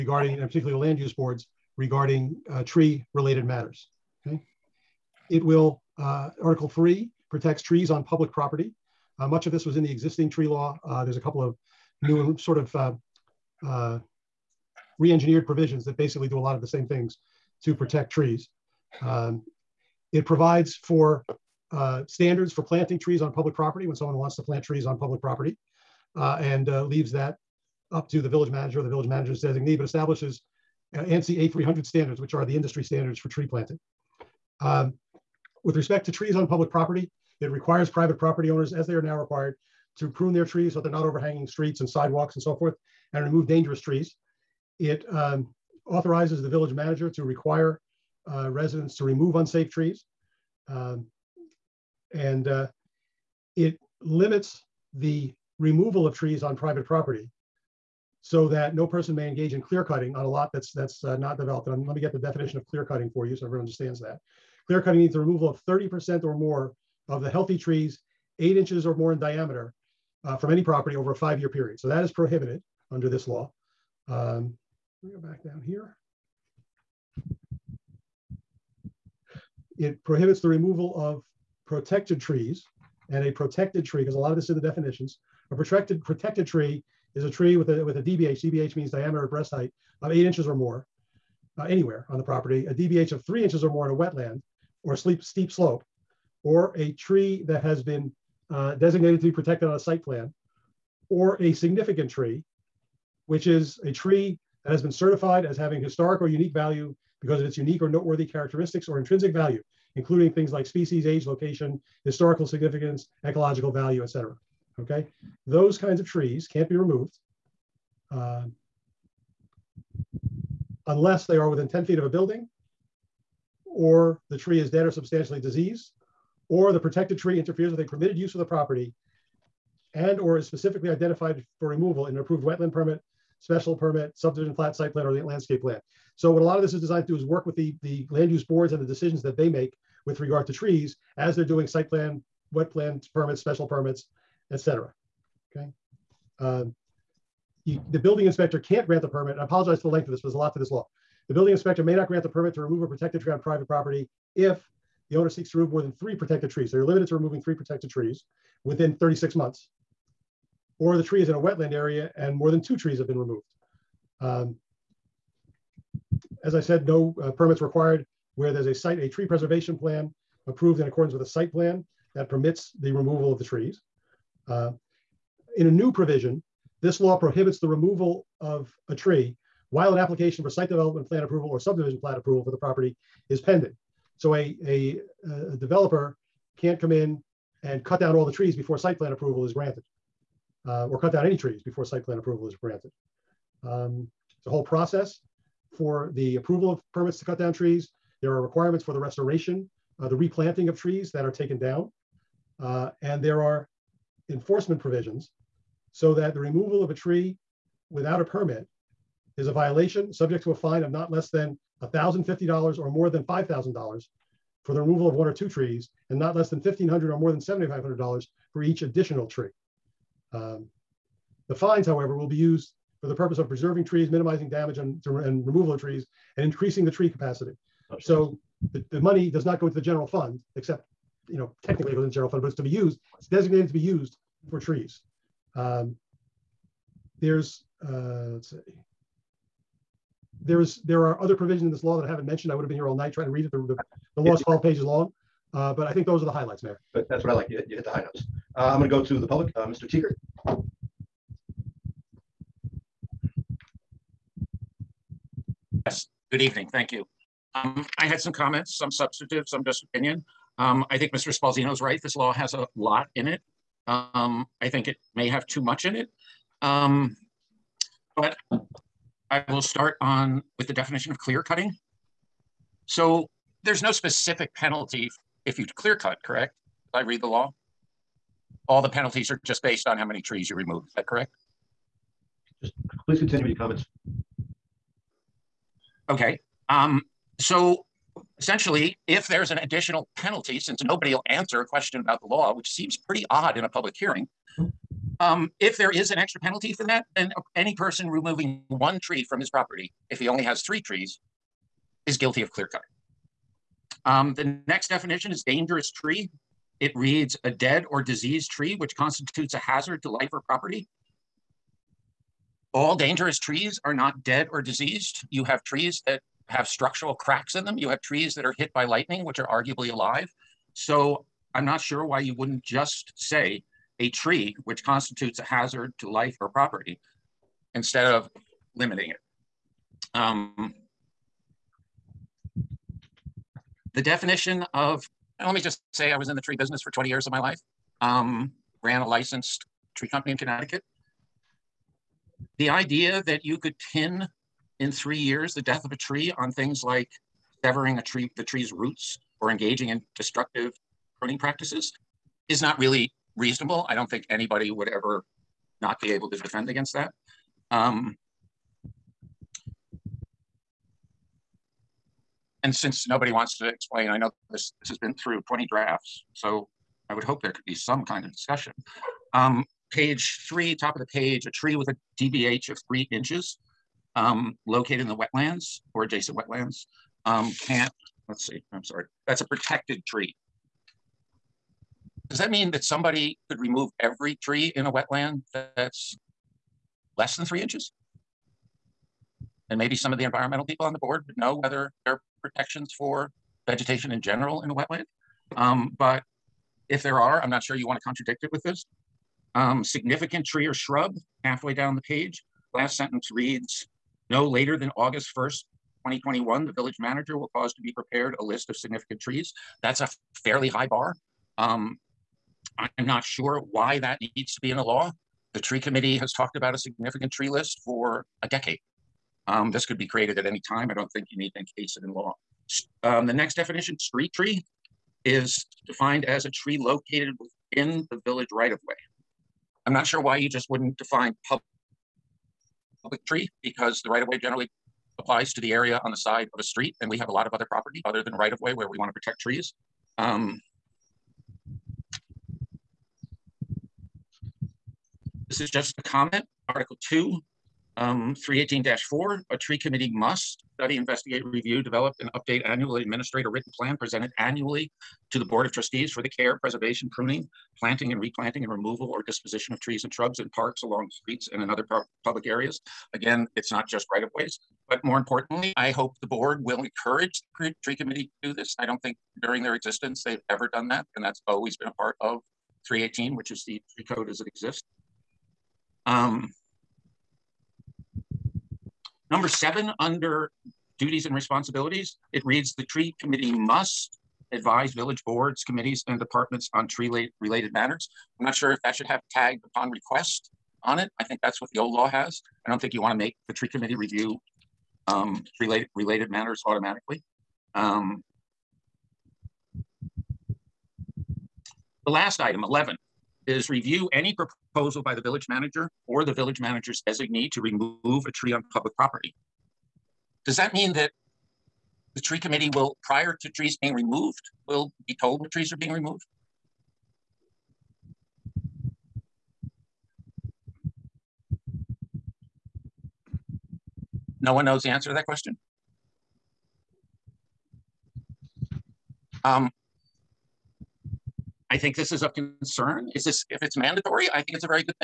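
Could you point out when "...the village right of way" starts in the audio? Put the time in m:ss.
7:08.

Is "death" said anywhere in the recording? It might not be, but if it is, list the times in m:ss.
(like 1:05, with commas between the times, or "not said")
5:45.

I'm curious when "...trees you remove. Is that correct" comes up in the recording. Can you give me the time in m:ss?
4:40.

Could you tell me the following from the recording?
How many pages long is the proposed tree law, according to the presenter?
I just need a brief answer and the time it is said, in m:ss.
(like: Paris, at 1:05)
12, at 4:04.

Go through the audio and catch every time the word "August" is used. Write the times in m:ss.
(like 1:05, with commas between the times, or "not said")
6:44.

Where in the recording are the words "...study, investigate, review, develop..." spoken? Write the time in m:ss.
7:30.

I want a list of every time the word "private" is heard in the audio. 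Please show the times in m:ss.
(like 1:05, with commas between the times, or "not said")
0:37, 0:56, 2:33.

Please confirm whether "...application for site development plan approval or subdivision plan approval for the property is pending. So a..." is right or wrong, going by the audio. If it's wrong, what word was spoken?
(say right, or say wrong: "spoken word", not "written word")
right.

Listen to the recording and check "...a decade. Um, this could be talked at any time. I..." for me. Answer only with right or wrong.
wrong.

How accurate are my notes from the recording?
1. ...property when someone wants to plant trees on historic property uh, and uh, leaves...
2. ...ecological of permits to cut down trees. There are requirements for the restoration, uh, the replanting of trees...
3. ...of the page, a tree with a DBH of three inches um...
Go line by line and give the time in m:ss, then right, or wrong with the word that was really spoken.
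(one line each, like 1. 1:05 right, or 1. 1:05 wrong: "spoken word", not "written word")
1. 0:23 wrong: "public", not "historic"
2. 3:16 wrong: "approval", not "ecological"
3. 6:10 right.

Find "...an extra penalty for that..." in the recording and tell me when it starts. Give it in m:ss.
4:56.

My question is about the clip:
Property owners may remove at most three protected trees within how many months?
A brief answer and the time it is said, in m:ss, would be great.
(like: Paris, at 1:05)
36 months, at 2:38.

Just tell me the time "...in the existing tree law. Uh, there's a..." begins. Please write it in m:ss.
0:09.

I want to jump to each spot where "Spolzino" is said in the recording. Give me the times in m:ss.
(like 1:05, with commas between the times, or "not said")
4:21.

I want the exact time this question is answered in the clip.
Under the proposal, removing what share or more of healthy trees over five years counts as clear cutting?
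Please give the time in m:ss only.
1:05.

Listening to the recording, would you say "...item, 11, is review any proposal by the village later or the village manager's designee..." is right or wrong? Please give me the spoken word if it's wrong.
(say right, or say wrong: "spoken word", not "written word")
wrong: "manager", not "later".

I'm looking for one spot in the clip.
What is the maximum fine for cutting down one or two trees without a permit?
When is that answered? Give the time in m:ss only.
3:33.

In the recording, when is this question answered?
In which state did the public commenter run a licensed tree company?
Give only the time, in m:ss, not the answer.
5:40.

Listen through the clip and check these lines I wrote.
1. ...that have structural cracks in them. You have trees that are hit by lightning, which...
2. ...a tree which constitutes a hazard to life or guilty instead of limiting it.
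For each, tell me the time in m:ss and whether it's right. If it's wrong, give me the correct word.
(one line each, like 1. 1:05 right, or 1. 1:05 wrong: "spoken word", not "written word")
1. 5:16 right
2. 5:23 wrong: "property", not "guilty".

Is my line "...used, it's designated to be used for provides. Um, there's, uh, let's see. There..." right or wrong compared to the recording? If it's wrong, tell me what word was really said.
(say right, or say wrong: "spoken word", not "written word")
wrong: "trees", not "provides".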